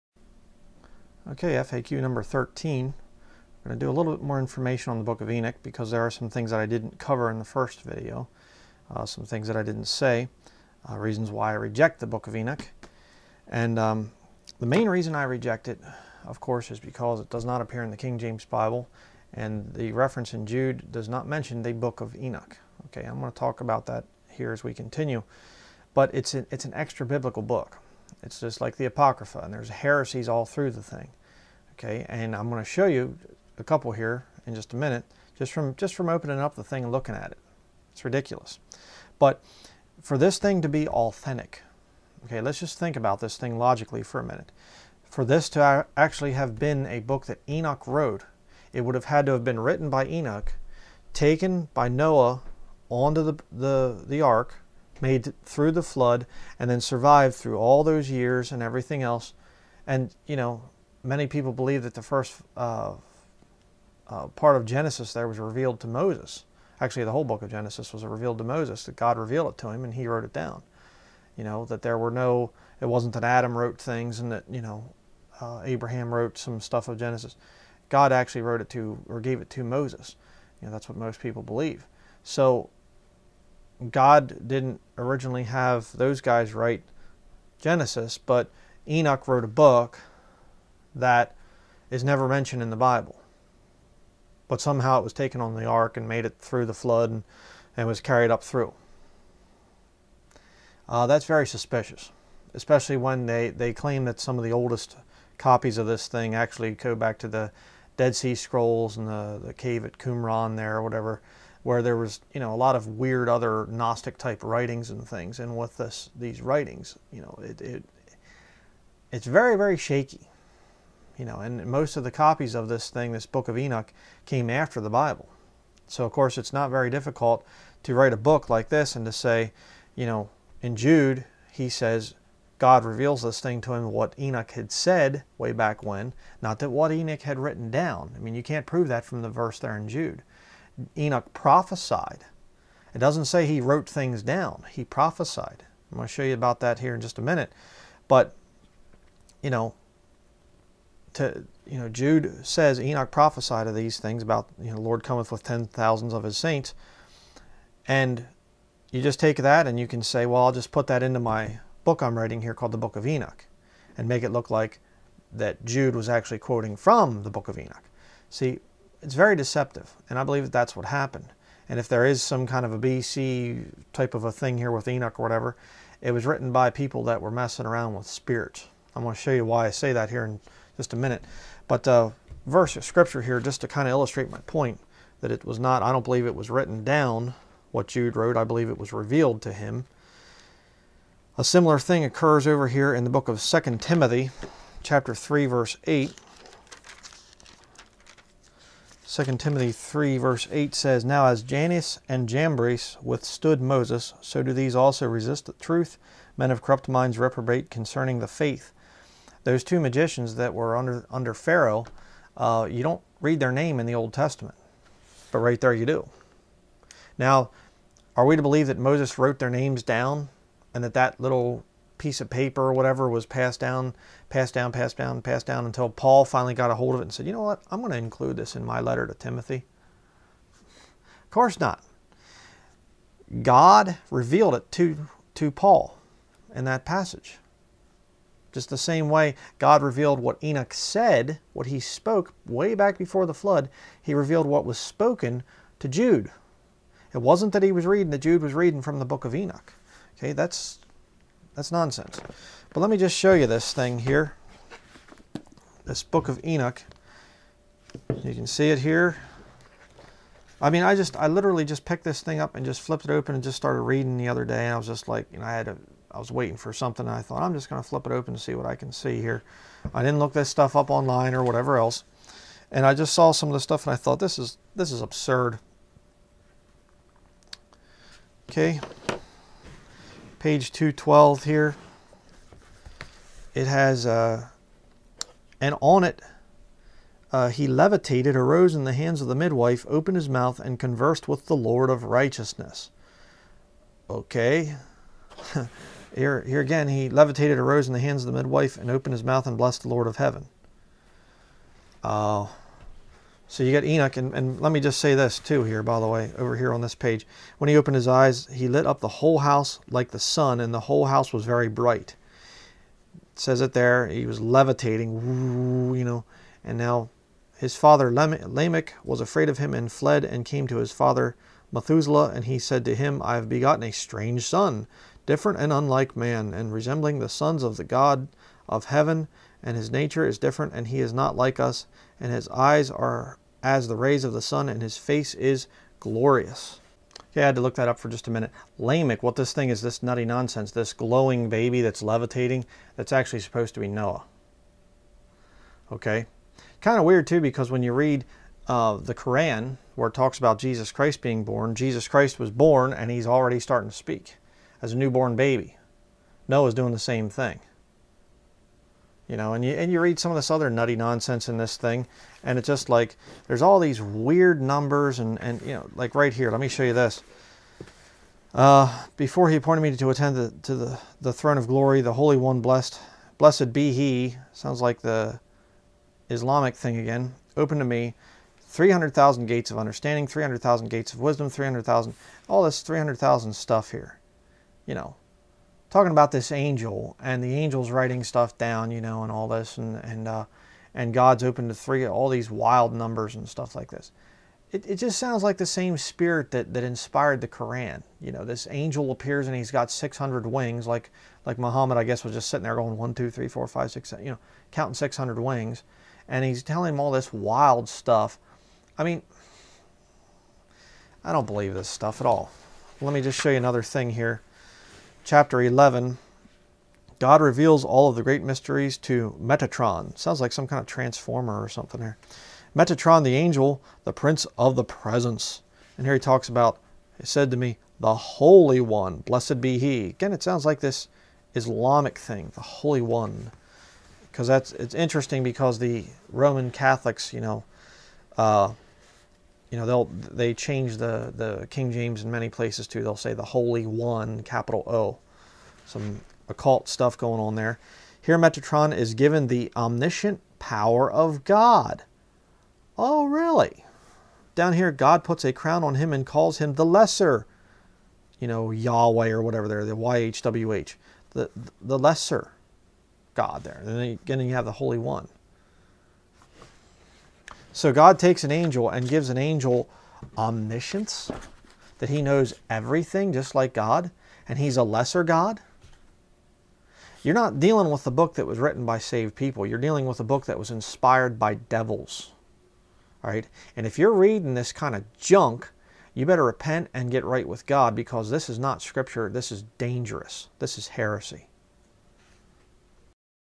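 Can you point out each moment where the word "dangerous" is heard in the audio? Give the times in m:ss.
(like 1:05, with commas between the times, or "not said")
8:09.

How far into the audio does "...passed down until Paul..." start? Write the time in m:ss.
3:45.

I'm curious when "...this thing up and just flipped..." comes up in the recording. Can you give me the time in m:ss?
4:22.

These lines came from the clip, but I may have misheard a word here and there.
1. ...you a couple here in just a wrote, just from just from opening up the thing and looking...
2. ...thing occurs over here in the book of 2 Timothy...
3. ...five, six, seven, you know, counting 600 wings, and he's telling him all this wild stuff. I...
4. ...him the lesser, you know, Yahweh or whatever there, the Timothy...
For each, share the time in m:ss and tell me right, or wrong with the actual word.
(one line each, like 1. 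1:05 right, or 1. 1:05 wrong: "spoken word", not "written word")
1. 0:32 wrong: "minute", not "wrote"
2. 3:11 right
3. 6:43 right
4. 7:36 wrong: "YHWH", not "Timothy".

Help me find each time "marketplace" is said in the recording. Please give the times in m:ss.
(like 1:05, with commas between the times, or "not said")
not said.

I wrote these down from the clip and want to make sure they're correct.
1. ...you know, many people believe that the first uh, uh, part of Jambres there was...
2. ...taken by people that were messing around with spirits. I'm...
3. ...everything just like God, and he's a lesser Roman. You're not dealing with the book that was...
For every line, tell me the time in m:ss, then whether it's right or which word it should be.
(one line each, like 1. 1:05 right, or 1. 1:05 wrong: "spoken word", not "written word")
1. 1:00 wrong: "Genesis", not "Jambres"
2. 2:56 wrong: "written", not "taken"
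3. 7:52 wrong: "God", not "Roman".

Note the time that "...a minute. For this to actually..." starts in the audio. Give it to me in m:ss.
0:44.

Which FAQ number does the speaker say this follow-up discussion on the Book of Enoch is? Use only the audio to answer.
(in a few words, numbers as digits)
13.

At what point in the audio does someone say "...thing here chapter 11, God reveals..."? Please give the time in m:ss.
6:53.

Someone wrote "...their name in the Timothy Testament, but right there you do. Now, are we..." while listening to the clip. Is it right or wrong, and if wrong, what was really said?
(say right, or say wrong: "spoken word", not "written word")
wrong: "Old", not "Timothy".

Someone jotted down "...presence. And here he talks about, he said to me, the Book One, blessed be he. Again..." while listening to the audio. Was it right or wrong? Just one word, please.
wrong.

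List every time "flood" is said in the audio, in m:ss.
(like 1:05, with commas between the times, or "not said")
0:55, 1:36, 4:03.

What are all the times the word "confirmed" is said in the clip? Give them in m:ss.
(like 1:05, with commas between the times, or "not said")
not said.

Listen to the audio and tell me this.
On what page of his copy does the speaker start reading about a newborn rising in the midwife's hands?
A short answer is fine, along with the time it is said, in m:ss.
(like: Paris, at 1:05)
212, at 4:40.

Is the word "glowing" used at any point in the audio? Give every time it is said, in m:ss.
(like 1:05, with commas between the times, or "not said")
5:40.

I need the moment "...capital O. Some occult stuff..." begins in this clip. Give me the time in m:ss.
7:24.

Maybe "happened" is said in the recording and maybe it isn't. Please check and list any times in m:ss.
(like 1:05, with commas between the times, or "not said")
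2:50.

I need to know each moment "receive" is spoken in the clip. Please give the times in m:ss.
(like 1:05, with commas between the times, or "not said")
not said.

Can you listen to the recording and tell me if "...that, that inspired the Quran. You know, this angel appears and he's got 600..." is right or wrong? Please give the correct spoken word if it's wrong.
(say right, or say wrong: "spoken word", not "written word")
right.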